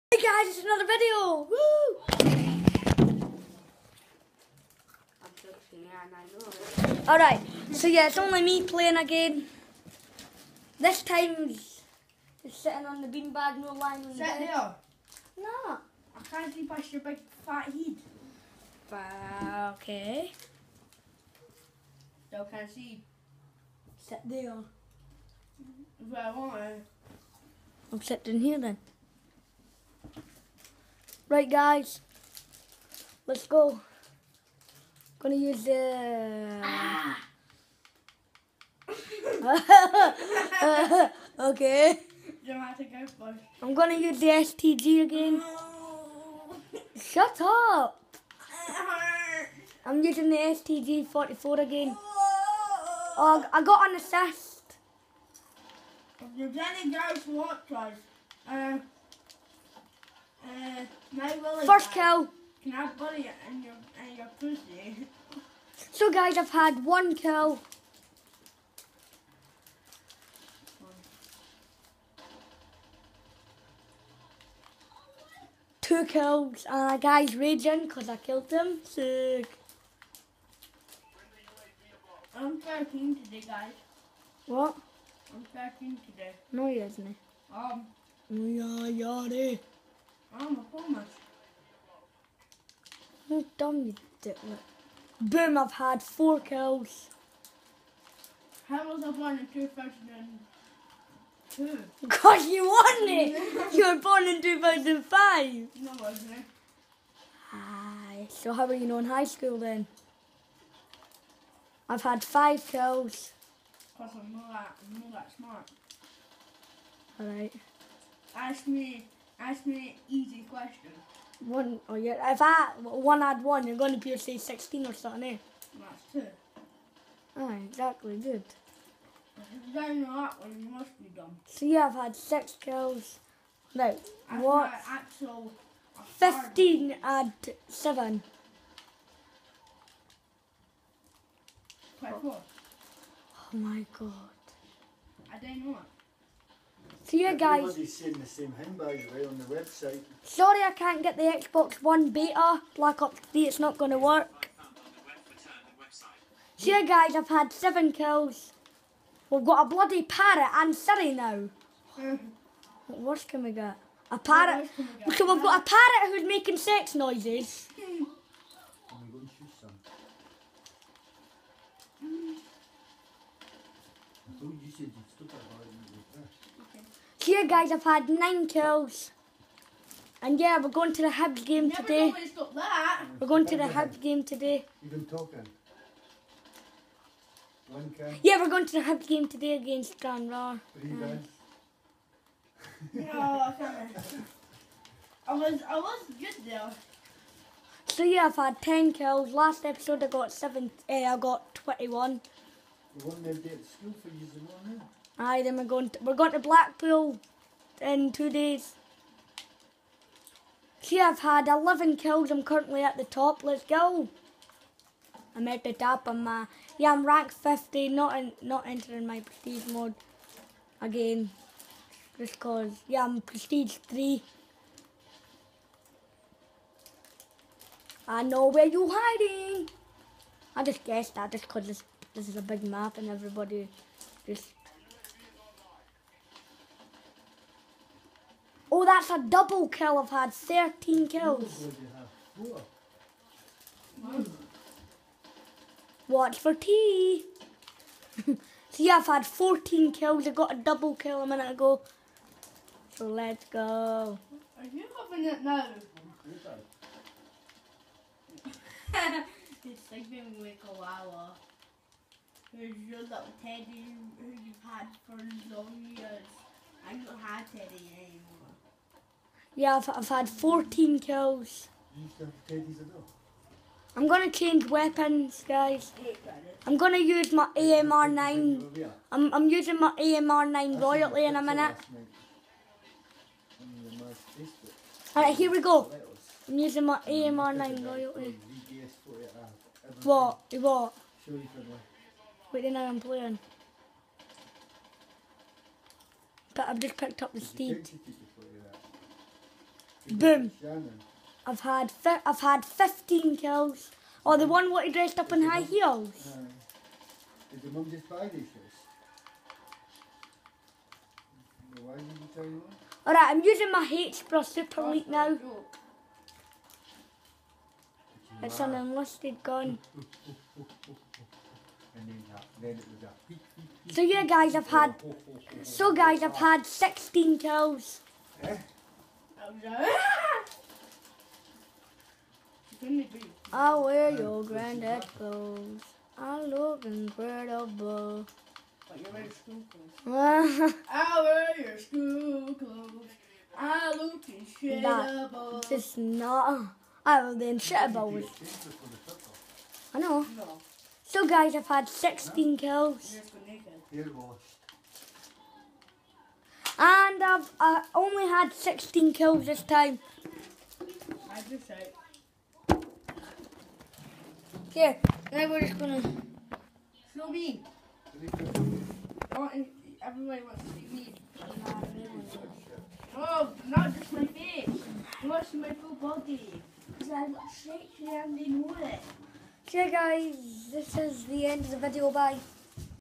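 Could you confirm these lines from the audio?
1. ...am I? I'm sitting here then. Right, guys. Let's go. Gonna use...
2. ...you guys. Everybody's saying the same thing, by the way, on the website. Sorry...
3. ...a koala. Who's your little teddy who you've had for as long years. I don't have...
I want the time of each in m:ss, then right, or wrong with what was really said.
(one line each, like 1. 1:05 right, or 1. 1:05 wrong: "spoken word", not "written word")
1. 0:26 right
2. 2:27 right
3. 4:20 right.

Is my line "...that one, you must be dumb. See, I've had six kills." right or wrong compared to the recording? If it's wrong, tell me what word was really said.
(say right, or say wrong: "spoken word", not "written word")
right.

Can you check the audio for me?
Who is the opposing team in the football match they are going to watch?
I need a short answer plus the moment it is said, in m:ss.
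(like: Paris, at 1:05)
Stranraer, at 3:09.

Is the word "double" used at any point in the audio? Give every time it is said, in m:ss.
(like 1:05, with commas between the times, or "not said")
3:59, 4:10.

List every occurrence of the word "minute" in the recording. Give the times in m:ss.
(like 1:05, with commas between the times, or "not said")
4:11, 4:41.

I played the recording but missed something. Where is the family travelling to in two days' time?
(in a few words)
Blackpool.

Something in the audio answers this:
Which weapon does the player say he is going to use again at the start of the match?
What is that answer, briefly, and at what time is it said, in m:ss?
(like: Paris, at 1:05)
STG 44, at 0:50.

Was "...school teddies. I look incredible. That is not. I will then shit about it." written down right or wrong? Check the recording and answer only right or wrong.
wrong.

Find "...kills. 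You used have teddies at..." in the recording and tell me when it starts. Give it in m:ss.
4:30.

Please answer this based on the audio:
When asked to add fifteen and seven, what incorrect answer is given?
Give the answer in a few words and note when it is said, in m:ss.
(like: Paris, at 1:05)
24, at 2:21.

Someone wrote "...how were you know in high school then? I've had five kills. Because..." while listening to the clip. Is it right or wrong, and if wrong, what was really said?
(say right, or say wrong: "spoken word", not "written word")
right.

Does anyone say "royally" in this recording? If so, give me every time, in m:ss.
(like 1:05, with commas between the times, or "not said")
4:40, 4:47.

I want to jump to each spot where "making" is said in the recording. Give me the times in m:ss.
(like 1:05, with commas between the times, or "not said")
2:46.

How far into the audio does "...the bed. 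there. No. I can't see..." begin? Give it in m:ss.
0:14.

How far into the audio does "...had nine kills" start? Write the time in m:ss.
2:57.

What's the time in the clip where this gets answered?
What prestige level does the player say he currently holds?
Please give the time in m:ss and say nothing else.
3:43.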